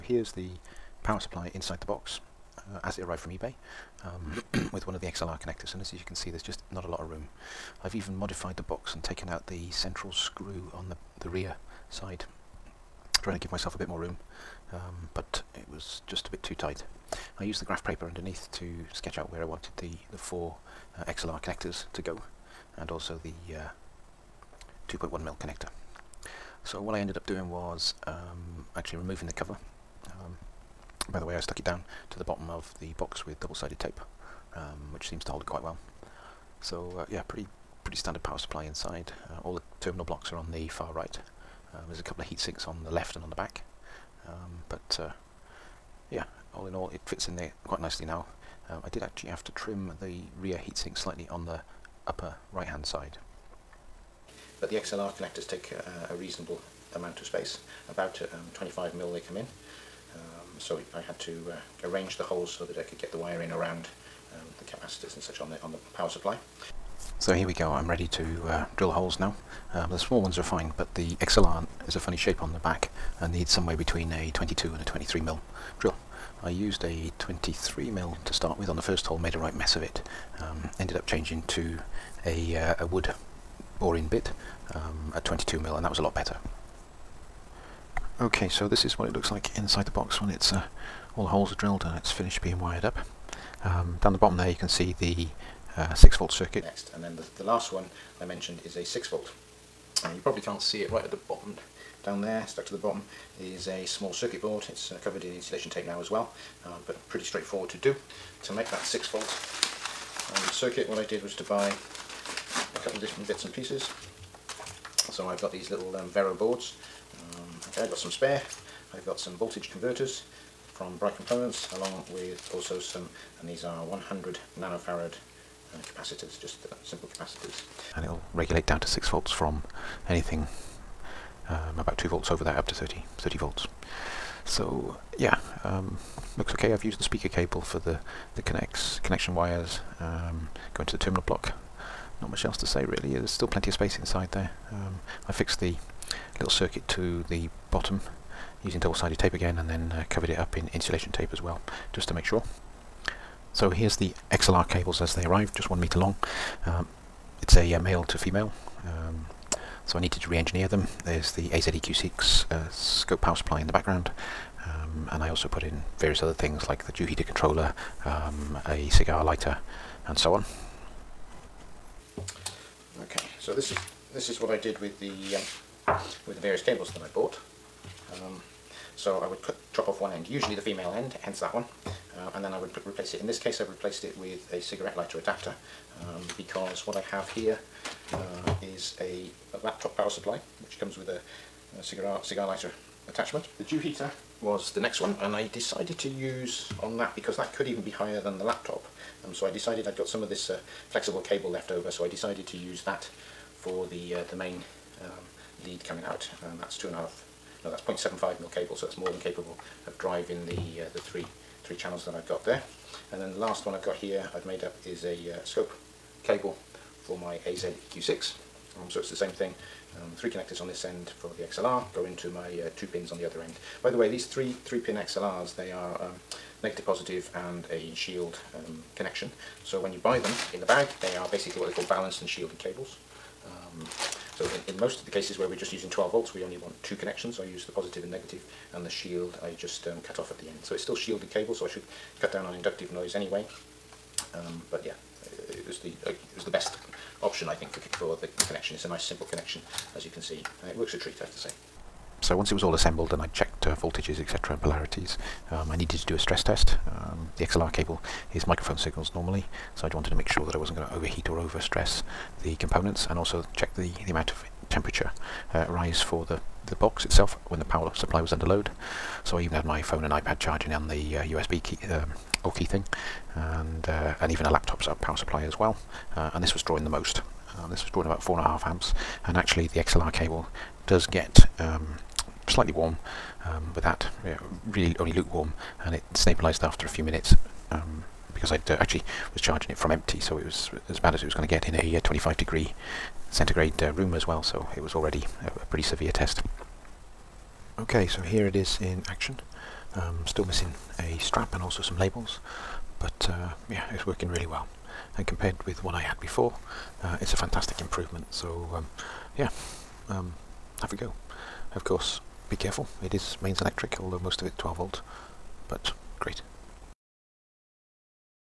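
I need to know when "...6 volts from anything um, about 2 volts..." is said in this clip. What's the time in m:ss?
2:08.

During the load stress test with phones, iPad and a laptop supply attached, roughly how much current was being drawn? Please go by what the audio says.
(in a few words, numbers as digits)
4.5 amps.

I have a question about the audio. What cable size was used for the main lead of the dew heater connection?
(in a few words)
0.75 mm.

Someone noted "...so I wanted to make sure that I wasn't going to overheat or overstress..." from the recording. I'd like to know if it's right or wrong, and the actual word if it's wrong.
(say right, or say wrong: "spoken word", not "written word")
right.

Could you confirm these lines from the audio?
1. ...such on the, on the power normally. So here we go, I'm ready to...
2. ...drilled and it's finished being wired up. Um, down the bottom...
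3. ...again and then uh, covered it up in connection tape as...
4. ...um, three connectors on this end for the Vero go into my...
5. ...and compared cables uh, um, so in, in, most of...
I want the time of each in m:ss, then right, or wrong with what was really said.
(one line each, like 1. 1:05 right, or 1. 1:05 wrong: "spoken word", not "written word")
1. 1:05 wrong: "supply", not "normally"
2. 1:31 right
3. 2:29 wrong: "insulation", not "connection"
4. 3:39 wrong: "XLR", not "Vero"
5. 3:52 wrong: "shielded", not "compared".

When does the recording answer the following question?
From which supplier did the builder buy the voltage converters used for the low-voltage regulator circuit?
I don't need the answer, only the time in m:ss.
2:00.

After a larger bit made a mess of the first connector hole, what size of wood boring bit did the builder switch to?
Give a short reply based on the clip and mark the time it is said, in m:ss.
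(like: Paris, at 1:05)
22 mm, at 1:25.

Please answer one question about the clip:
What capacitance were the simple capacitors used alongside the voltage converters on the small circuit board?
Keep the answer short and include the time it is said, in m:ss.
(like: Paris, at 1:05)
100 nanofarad, at 2:03.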